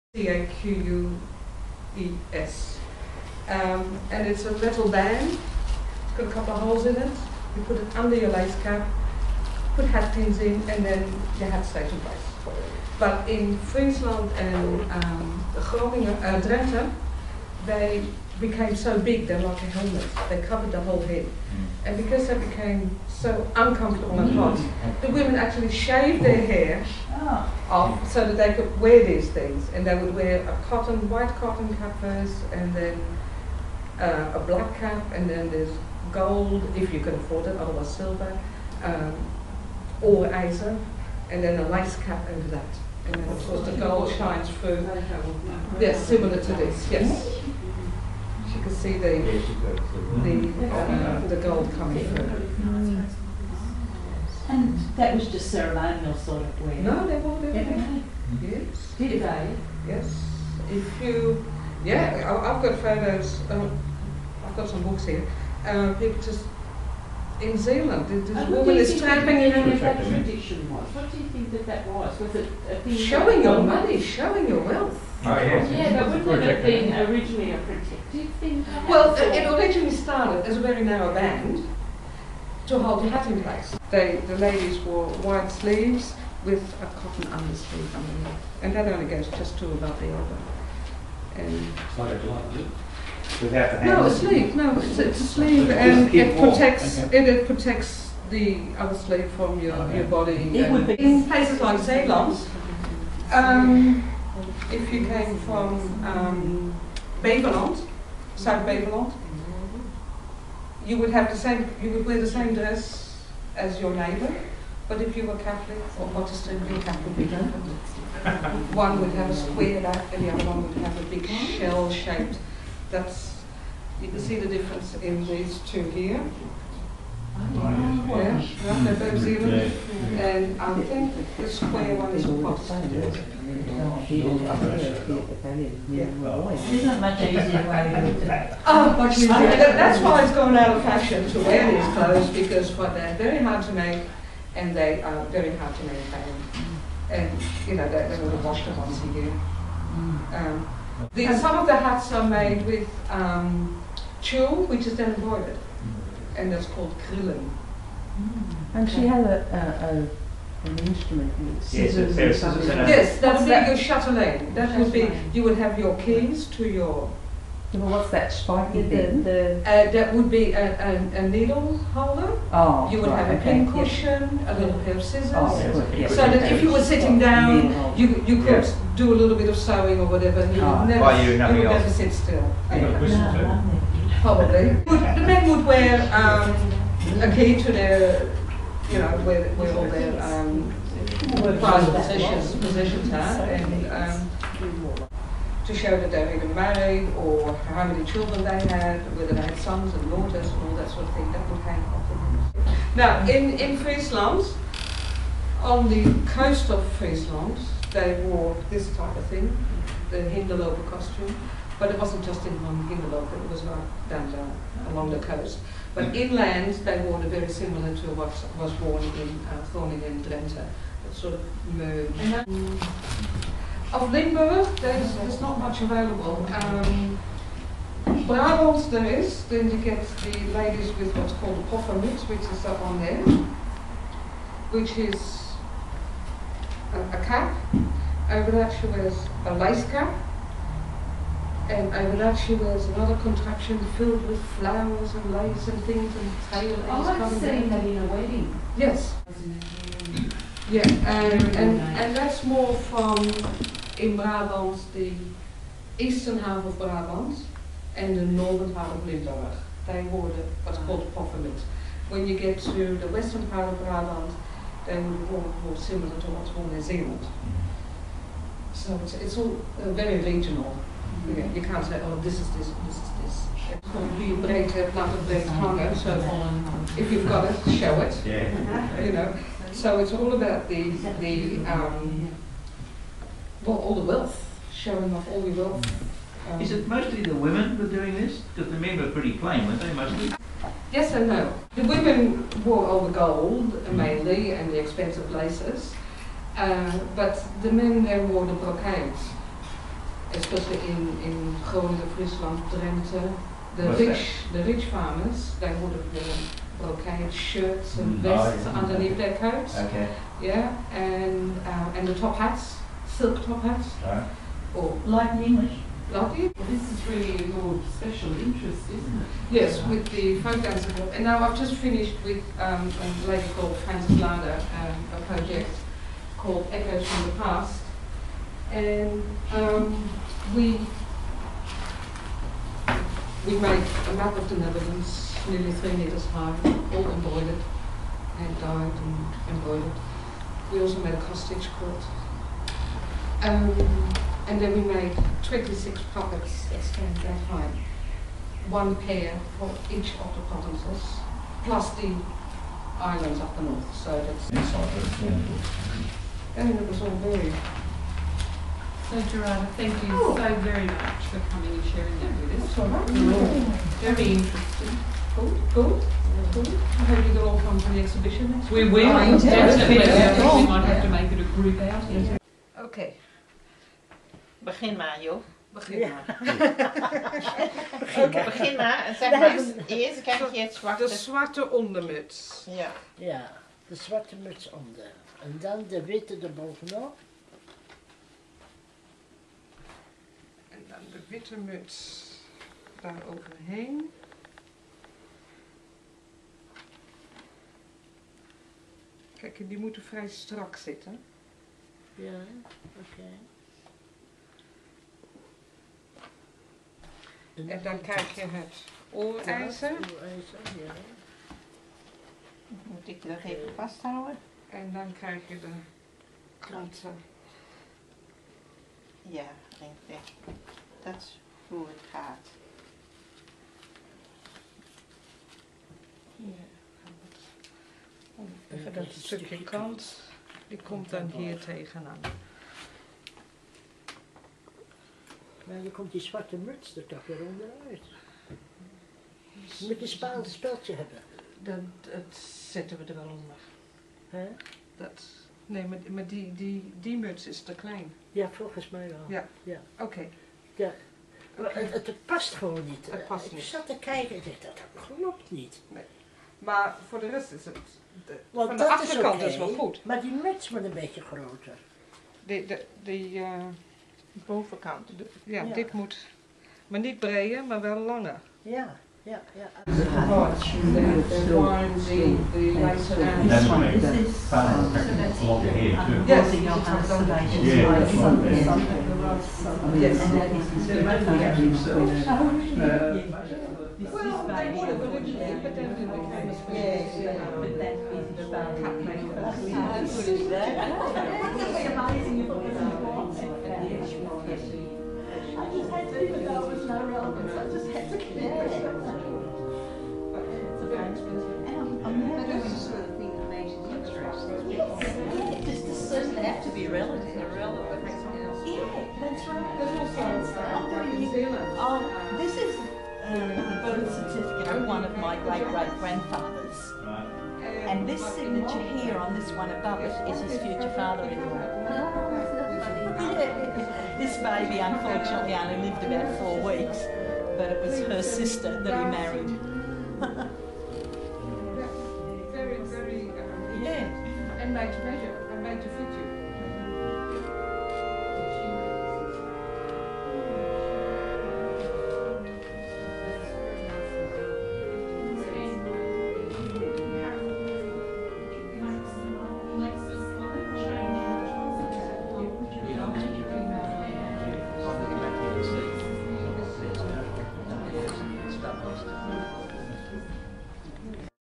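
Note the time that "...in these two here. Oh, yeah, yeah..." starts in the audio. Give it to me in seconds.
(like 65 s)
124 s.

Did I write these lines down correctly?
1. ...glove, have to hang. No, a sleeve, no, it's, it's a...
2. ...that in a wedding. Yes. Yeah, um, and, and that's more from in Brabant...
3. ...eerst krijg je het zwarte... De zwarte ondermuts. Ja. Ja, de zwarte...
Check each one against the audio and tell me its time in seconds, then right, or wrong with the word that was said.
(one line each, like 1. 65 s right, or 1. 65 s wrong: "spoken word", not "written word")
1. 92 s right
2. 247 s right
3. 379 s right.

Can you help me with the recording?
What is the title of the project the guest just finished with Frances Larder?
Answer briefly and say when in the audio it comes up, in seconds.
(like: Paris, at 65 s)
Echoes from the Past, at 326 s.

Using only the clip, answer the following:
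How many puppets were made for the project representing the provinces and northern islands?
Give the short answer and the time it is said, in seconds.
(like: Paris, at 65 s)
26, at 345 s.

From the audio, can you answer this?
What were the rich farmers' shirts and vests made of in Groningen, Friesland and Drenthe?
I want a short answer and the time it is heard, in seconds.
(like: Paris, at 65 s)
Brocade, at 306 s.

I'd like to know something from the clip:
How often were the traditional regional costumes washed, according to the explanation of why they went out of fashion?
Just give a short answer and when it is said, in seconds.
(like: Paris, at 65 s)
Once a year, at 148 s.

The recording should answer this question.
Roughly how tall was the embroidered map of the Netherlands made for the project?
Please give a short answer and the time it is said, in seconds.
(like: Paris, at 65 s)
3 metres, at 335 s.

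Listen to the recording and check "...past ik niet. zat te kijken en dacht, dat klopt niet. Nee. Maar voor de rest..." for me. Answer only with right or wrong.
right.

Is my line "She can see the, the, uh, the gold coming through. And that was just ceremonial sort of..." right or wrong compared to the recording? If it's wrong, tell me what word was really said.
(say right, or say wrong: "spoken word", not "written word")
right.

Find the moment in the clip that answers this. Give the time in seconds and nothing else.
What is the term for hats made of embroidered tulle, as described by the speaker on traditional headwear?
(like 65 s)
156 s.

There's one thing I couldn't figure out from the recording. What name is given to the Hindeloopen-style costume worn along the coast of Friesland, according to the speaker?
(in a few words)
Hindelooper costume.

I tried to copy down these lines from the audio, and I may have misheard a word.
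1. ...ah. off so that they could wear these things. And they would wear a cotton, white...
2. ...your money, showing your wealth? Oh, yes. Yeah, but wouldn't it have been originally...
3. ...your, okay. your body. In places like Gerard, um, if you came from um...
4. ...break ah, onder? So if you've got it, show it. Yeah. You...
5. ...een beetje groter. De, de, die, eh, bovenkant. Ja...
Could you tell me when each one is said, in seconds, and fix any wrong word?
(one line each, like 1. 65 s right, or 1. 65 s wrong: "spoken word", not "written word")
1. 27 s right
2. 73 s right
3. 99 s wrong: "Zeeland", not "Gerard"
4. 275 s wrong: "hunger", not "onder"
5. 460 s right.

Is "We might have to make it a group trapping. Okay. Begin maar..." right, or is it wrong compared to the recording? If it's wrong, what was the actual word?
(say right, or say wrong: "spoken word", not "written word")
wrong: "outing", not "trapping".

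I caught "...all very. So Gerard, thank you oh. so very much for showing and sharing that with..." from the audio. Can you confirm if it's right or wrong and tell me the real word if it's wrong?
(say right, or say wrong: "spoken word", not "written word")
wrong: "coming", not "showing".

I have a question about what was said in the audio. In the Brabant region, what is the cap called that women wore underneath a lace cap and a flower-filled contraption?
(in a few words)
poffermuts.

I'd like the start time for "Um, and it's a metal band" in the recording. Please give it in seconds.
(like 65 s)
3 s.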